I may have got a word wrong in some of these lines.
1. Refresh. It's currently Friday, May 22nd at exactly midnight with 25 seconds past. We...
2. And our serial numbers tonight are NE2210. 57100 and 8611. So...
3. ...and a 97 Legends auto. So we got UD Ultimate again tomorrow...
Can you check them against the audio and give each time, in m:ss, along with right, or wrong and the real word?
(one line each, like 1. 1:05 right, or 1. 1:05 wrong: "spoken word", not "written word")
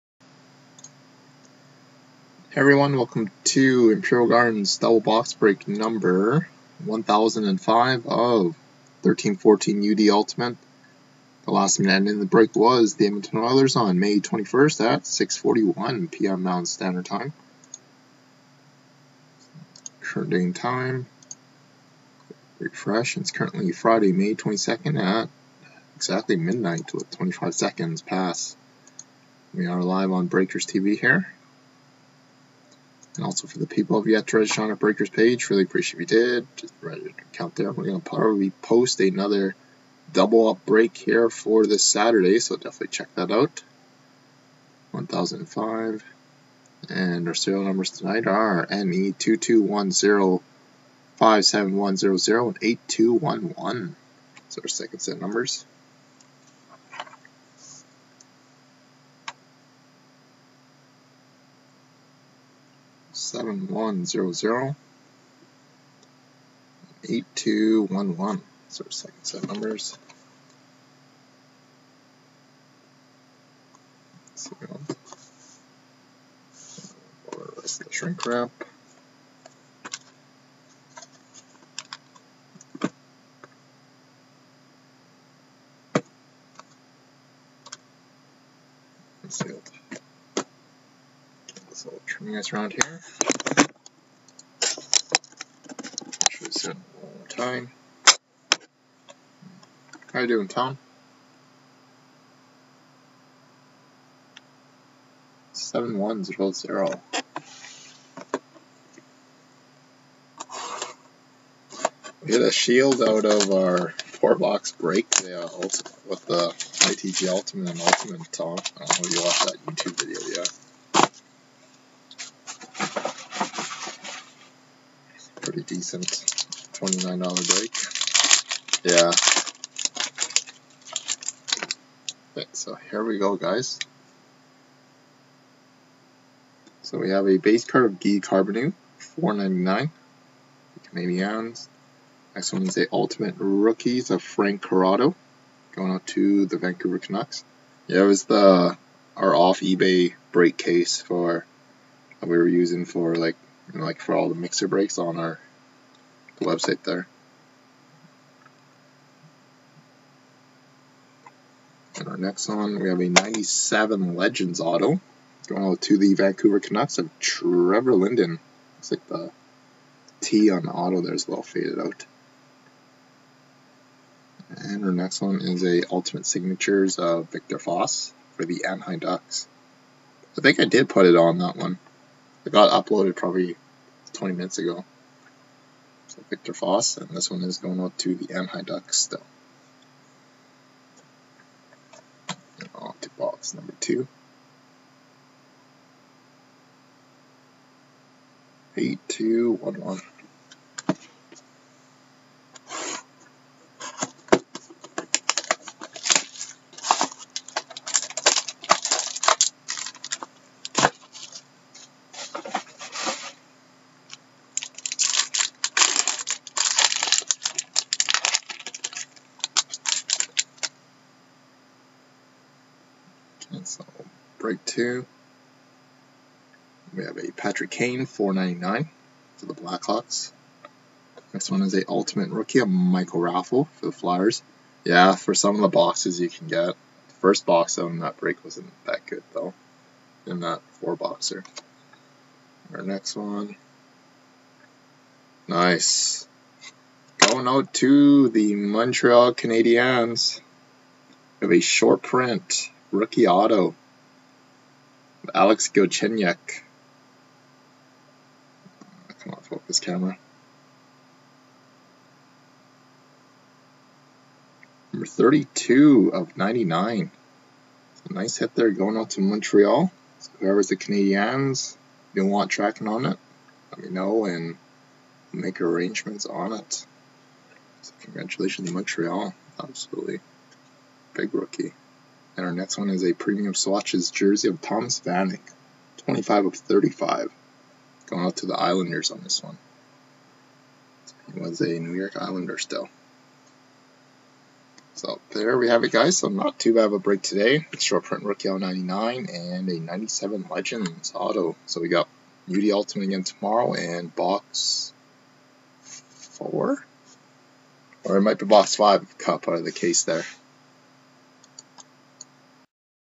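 1. 0:22 right
2. 0:46 wrong: "8211", not "8611"
3. 4:59 right.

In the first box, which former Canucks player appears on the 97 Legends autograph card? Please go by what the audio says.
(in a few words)
Trevor Linden.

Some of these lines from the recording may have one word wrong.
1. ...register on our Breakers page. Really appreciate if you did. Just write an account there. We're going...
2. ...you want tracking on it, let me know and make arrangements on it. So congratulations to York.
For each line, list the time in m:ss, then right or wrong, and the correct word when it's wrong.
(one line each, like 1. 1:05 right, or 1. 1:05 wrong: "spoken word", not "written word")
1. 0:34 right
2. 4:32 wrong: "Montreal", not "York".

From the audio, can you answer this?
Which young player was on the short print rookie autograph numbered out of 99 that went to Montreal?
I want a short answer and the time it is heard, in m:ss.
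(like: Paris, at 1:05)
Alex Galchenyuk, at 4:15.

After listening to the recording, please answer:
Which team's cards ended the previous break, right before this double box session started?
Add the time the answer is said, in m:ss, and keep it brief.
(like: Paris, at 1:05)
Edmonton Oilers, at 0:13.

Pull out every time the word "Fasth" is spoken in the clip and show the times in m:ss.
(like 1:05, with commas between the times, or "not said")
2:57, 3:06.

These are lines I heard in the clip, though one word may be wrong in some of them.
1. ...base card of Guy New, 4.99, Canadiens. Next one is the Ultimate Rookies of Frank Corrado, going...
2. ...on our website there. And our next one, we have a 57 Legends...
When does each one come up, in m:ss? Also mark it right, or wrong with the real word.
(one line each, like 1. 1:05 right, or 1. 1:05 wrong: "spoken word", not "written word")
1. 2:17 wrong: "Carbonneau", not "New"
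2. 2:34 wrong: "97", not "57".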